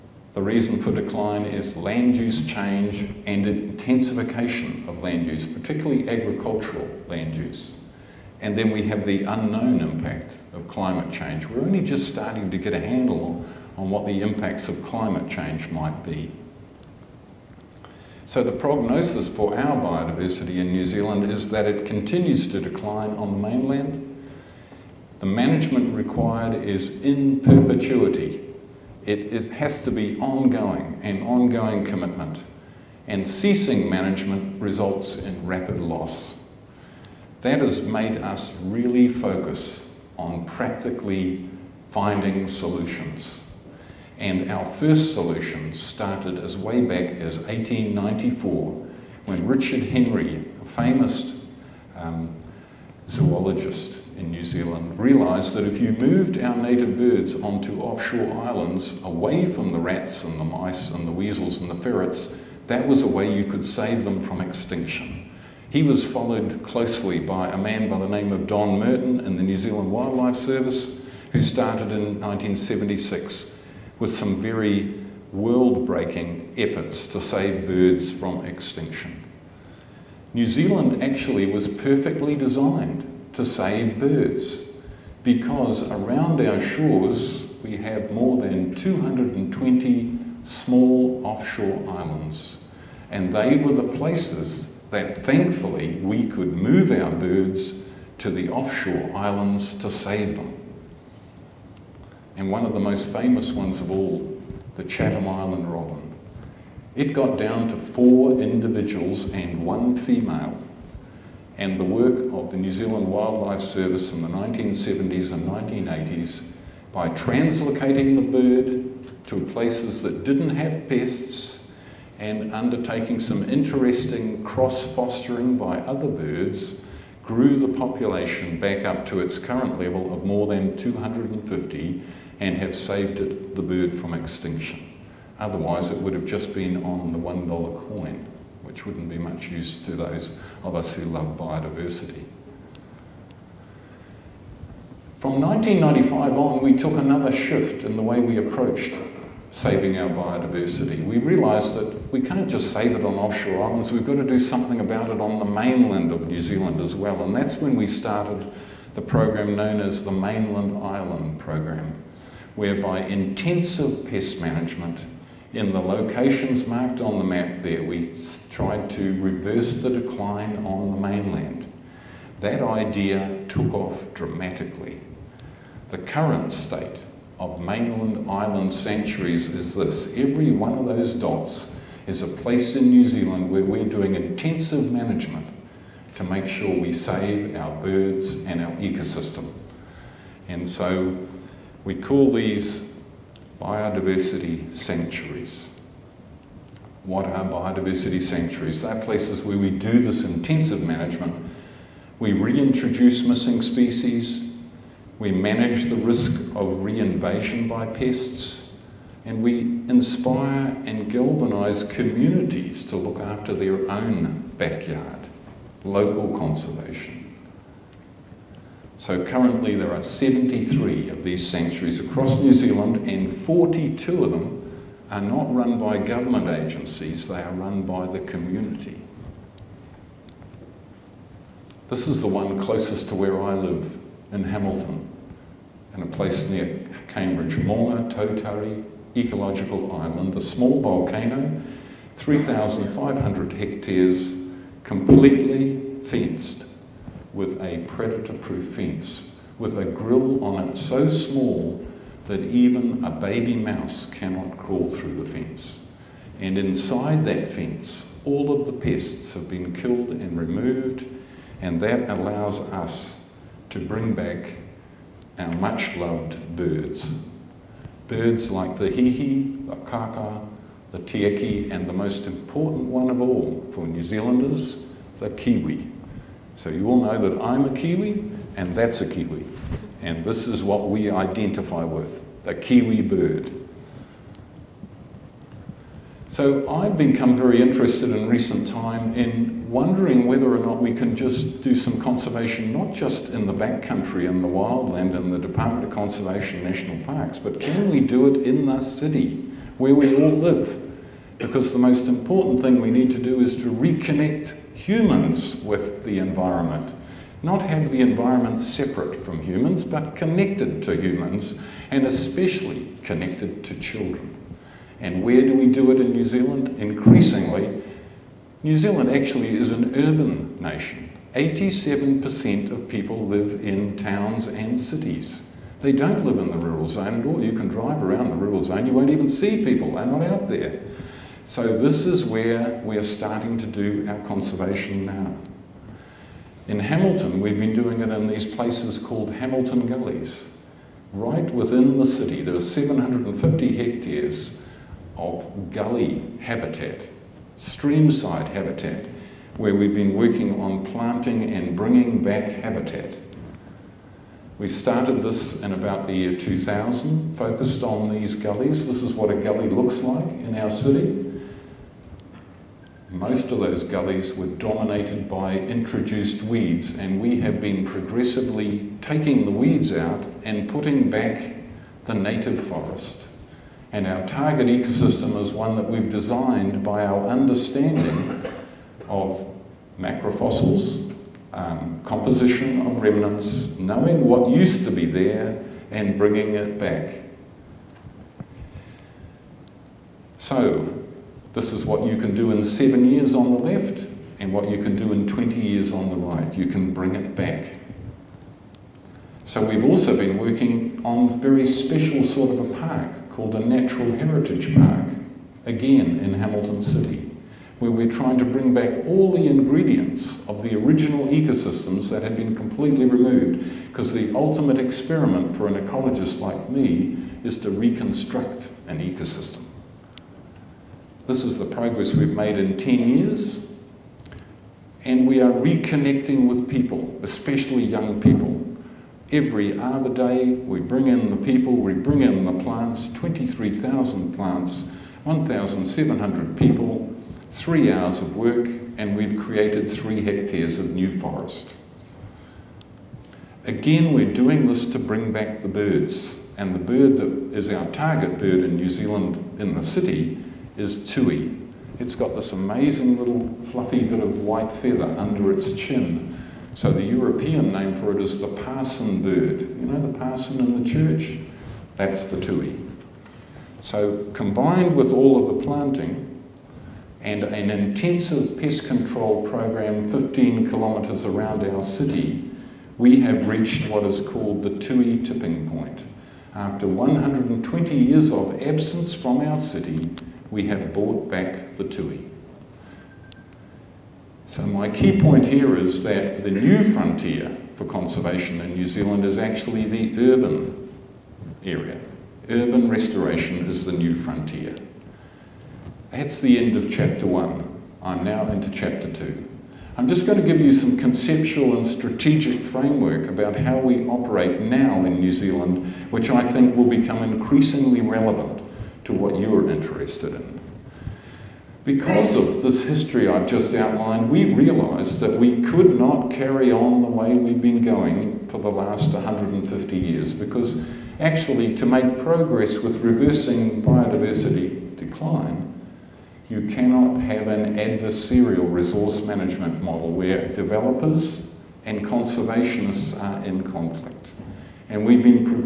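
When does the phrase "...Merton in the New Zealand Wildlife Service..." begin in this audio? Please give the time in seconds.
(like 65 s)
68 s.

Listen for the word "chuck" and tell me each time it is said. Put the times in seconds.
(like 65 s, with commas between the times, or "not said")
not said.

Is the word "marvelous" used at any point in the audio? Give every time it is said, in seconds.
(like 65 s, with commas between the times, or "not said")
not said.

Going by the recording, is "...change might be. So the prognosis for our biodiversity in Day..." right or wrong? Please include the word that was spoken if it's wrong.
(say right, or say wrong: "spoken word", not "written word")
wrong: "New", not "Day".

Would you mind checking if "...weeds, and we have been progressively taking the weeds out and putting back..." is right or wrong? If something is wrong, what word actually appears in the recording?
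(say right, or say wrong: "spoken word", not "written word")
right.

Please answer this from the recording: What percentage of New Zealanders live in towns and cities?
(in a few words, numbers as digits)
87%.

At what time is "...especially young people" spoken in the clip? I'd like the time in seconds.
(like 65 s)
427 s.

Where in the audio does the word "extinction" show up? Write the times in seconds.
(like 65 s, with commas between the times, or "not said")
64 s, 78 s, 134 s.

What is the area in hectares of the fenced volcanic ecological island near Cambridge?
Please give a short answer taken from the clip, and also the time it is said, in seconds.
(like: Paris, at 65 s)
3,500, at 242 s.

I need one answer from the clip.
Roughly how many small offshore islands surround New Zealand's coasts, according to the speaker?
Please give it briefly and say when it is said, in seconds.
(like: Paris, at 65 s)
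More than 220, at 88 s.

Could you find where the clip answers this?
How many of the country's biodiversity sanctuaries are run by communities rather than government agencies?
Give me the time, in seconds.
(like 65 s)
223 s.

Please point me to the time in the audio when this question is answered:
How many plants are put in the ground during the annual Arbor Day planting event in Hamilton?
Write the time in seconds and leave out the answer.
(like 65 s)
433 s.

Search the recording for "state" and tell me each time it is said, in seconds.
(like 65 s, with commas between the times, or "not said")
176 s.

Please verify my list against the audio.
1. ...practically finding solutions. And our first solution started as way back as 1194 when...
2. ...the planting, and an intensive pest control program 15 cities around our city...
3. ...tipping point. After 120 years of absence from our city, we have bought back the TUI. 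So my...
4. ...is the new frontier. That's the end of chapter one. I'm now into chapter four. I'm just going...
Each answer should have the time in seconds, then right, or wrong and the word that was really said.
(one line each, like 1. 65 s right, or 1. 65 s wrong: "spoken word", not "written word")
1. 40 s wrong: "1894", not "1194"
2. 465 s wrong: "kilometres", not "cities"
3. 475 s right
4. 493 s wrong: "two", not "four".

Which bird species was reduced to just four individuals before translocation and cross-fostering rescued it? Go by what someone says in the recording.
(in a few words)
Chatham Island robin.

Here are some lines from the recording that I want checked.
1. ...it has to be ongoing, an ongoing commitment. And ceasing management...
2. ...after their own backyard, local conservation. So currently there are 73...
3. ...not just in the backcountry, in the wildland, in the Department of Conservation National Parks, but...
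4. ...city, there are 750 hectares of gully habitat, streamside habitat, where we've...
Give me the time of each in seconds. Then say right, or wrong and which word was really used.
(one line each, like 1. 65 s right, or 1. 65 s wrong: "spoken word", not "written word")
1. 29 s right
2. 213 s right
3. 292 s right
4. 342 s right.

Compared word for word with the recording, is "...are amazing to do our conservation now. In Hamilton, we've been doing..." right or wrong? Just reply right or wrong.
wrong.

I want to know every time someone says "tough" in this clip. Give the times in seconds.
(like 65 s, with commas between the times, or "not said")
not said.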